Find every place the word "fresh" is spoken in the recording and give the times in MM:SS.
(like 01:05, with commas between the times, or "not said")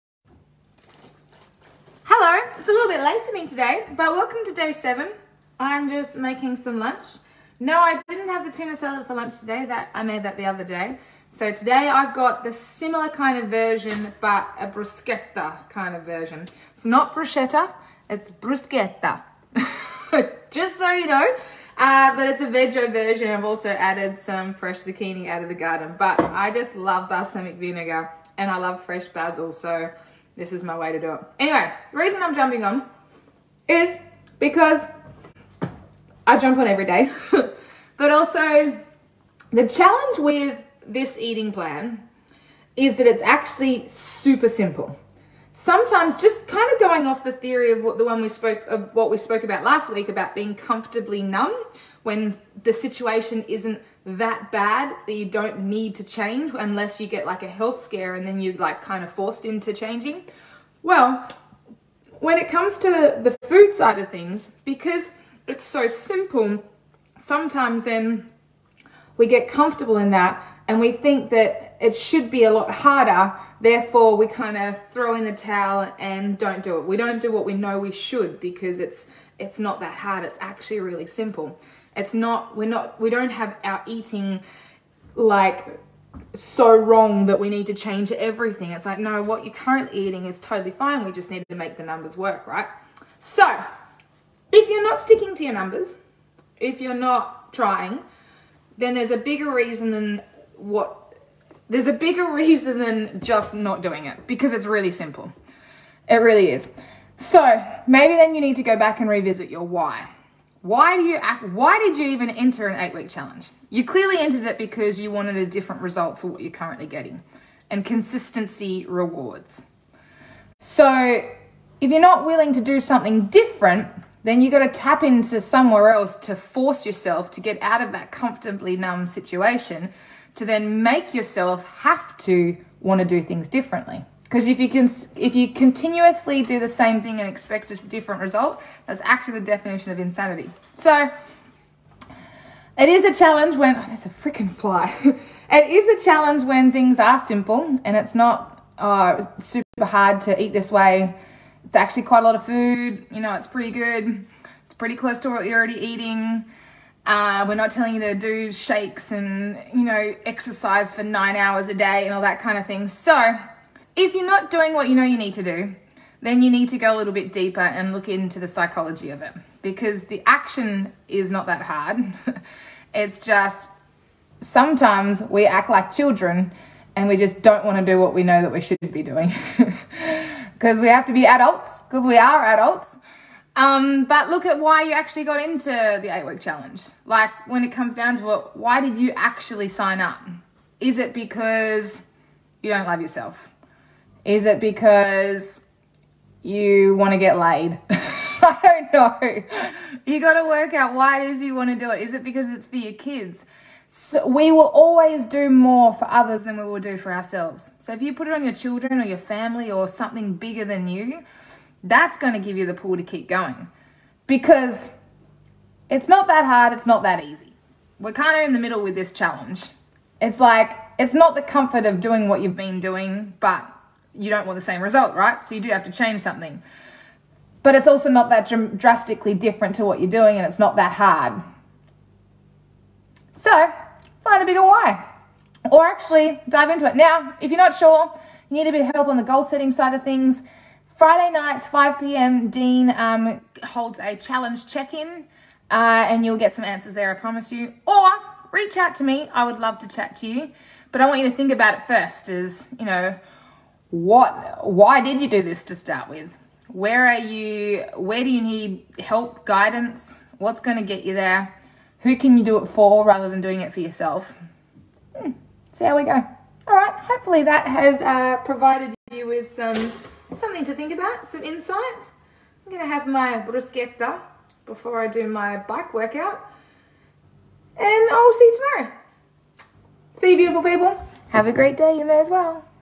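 00:24, 00:28.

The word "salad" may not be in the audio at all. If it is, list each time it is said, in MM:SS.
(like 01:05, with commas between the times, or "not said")
00:08.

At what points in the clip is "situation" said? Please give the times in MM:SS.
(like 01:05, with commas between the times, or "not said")
00:52, 02:09.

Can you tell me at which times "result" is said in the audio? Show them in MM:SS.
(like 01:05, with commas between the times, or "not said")
01:55, 02:18, 03:44.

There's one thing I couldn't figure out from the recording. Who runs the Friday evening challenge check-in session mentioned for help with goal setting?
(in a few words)
Dean.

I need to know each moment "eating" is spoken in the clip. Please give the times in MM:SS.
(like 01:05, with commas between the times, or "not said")
00:41, 01:23, 01:30, 02:35.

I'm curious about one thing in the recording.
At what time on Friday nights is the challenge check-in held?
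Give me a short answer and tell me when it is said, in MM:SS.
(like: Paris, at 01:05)
5 p.m., at 04:01.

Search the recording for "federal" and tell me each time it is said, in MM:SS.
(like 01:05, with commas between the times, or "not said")
not said.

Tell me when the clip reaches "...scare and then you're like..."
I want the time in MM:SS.
00:57.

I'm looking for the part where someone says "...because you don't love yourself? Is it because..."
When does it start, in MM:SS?
03:11.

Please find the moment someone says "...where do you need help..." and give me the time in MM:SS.
04:17.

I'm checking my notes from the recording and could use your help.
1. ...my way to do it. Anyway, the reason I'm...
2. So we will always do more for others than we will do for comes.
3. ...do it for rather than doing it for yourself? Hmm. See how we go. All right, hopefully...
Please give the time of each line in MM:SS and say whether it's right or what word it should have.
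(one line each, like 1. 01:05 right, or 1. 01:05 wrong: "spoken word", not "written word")
1. 00:30 right
2. 03:23 wrong: "ourselves", not "comes"
3. 04:22 right.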